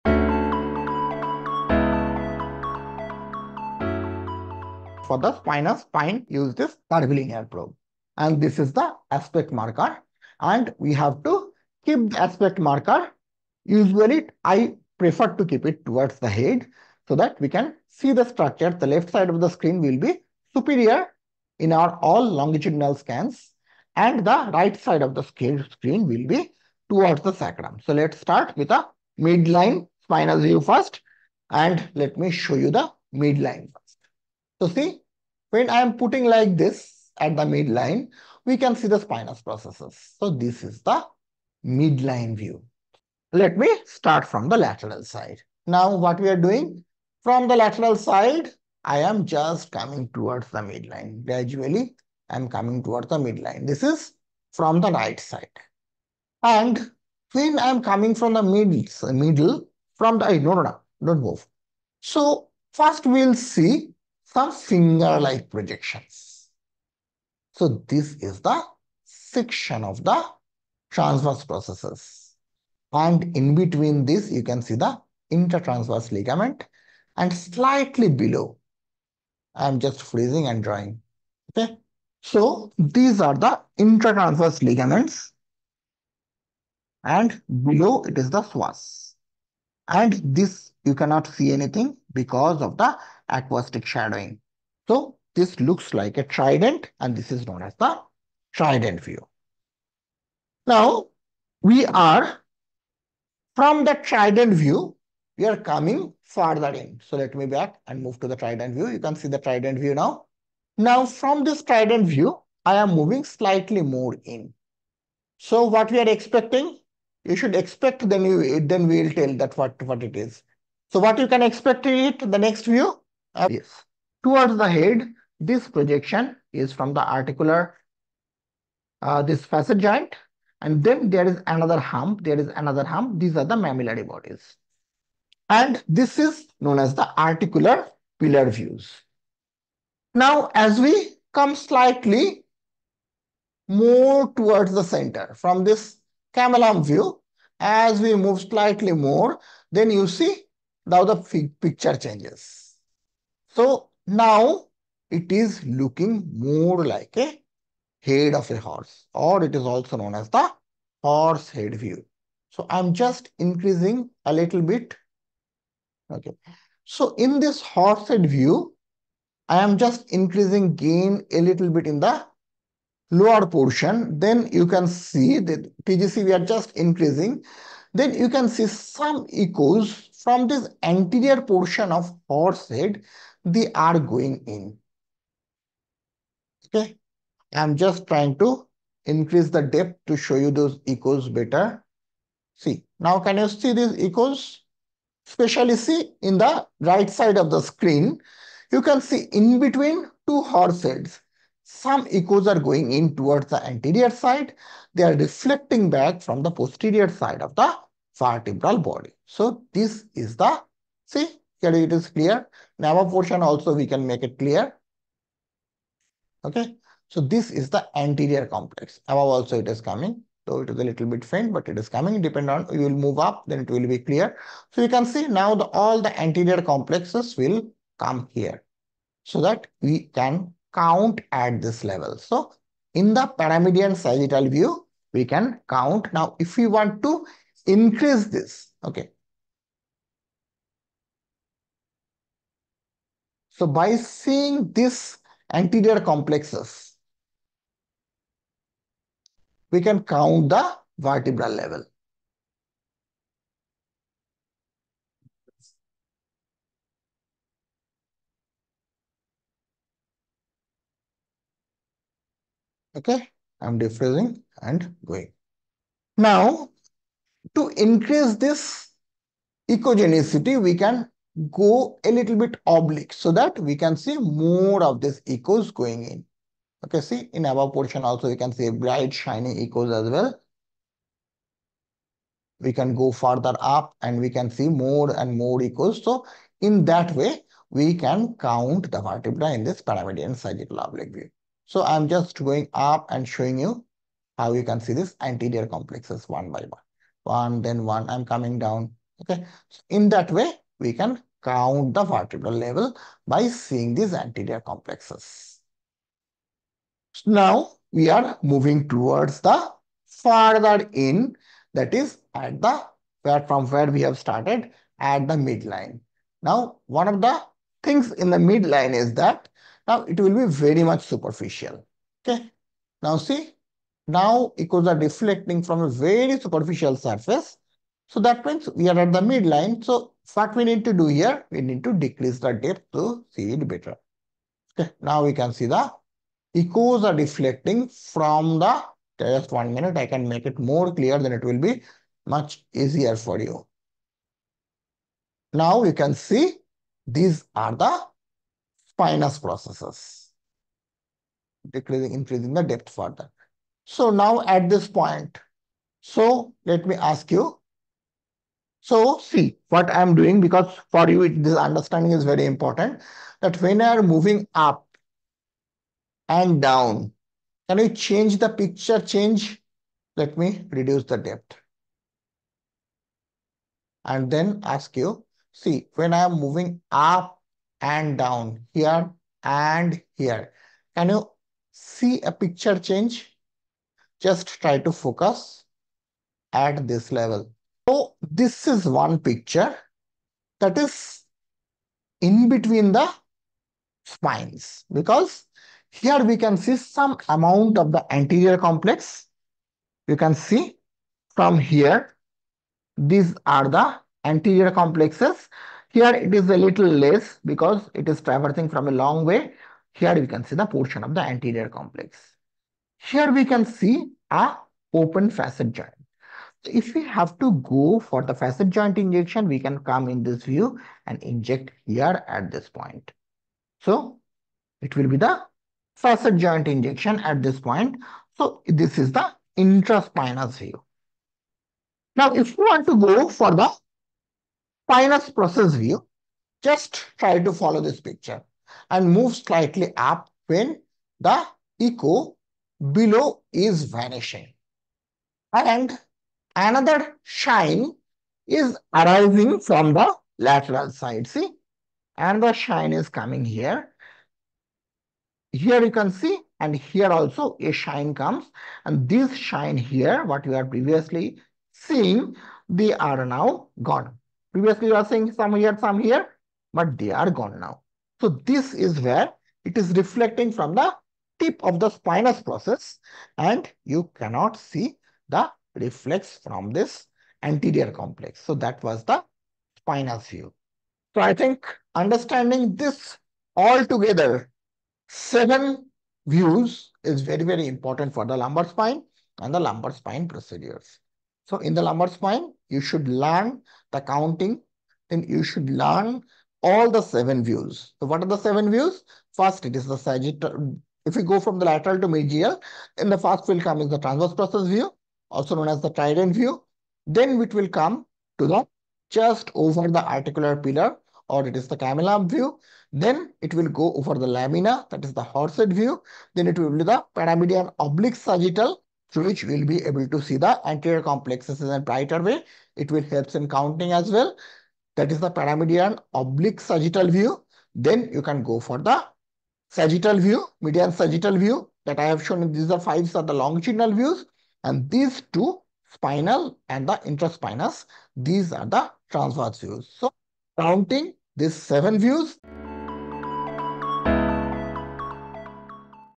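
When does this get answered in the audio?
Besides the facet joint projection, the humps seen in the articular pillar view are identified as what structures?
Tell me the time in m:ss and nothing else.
2:13.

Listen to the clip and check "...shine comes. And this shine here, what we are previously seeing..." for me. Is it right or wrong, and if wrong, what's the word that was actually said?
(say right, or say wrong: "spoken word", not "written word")
right.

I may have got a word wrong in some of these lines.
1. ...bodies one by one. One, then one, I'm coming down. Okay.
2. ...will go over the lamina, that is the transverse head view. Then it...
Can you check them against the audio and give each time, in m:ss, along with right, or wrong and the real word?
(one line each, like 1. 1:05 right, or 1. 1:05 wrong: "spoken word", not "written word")
1. 4:55 wrong: "complexes", not "bodies"
2. 8:33 wrong: "horse", not "transverse".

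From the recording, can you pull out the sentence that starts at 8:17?
So what are the seven views?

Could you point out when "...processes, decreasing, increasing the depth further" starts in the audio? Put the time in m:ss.
5:49.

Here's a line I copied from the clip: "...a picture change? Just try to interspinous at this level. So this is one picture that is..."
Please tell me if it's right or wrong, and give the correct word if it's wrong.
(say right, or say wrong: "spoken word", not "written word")
wrong: "focus", not "interspinous".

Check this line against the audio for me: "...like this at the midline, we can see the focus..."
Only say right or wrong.
wrong.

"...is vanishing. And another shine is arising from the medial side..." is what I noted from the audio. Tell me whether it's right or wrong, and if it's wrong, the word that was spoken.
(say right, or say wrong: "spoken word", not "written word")
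wrong: "lateral", not "medial".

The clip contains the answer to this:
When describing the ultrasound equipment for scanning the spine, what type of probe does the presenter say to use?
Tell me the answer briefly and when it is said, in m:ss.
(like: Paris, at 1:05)
curvilinear probe, at 0:06.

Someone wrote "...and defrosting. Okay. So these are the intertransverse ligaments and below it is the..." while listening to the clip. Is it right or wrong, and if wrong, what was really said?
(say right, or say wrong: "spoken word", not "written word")
wrong: "drawing", not "defrosting".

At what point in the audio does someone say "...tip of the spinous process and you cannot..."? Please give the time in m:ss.
7:51.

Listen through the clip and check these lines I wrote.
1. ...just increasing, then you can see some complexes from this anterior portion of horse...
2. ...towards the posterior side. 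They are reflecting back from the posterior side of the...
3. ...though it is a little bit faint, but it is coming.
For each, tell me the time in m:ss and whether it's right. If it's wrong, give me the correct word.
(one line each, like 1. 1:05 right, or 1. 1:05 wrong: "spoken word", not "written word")
1. 2:56 wrong: "echoes", not "complexes"
2. 3:23 wrong: "anterior", not "posterior"
3. 3:40 right.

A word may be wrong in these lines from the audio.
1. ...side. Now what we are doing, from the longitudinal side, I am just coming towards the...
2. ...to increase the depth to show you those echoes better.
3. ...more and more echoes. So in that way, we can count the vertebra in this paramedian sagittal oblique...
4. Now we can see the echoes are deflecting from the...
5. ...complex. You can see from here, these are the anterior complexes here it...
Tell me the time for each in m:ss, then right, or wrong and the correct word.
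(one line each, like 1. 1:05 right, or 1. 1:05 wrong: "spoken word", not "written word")
1. 0:45 wrong: "lateral", not "longitudinal"
2. 3:08 right
3. 4:44 right
4. 5:35 right
5. 6:38 right.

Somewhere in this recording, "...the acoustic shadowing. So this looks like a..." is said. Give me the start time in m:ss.
1:32.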